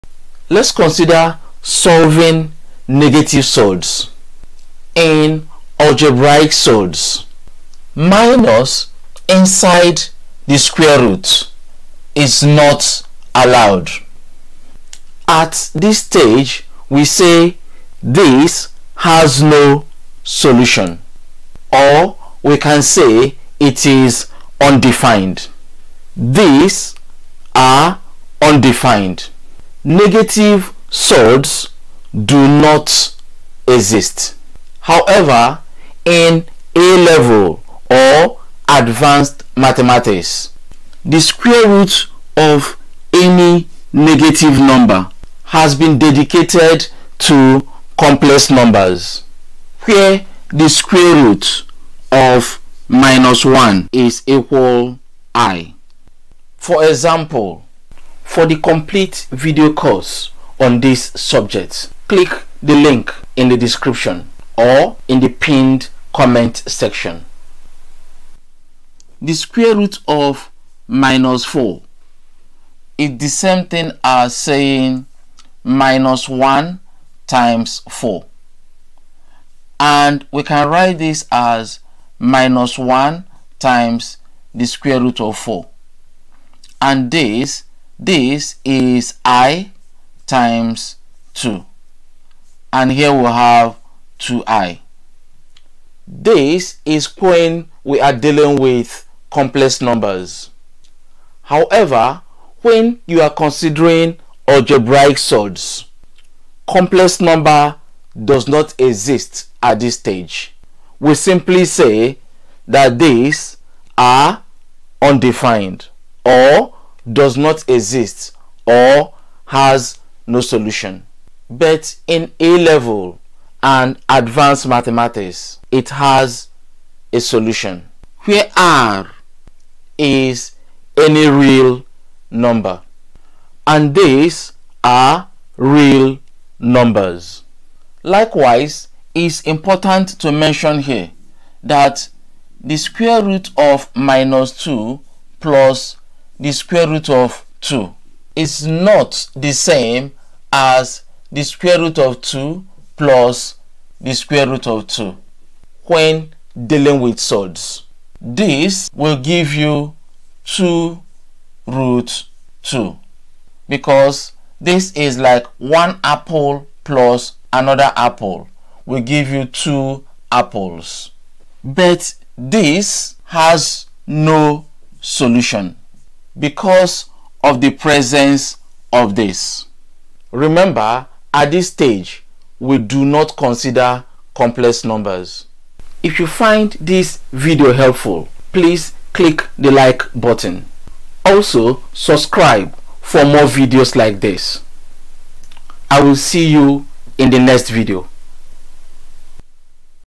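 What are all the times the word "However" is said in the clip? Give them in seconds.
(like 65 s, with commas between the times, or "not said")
34 s, 101 s.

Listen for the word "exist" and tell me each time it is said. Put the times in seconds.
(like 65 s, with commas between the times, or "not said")
33 s, 108 s, 117 s.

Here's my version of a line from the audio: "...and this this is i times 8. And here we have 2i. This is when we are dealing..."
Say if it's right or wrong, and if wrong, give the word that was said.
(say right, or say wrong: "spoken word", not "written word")
wrong: "2", not "8".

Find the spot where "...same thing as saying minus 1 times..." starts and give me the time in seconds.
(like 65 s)
73 s.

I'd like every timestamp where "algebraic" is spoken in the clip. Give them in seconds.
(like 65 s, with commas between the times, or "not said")
5 s, 104 s.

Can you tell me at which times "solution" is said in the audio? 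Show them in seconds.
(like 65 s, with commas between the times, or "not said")
20 s, 120 s, 127 s, 174 s.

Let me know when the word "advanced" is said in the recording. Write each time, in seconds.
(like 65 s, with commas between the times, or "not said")
38 s, 124 s.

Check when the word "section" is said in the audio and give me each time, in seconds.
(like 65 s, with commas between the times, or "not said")
66 s.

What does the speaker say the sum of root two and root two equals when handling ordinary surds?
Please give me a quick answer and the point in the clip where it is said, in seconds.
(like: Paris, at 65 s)
2 root 2, at 160 s.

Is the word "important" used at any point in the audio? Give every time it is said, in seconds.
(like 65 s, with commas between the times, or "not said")
139 s.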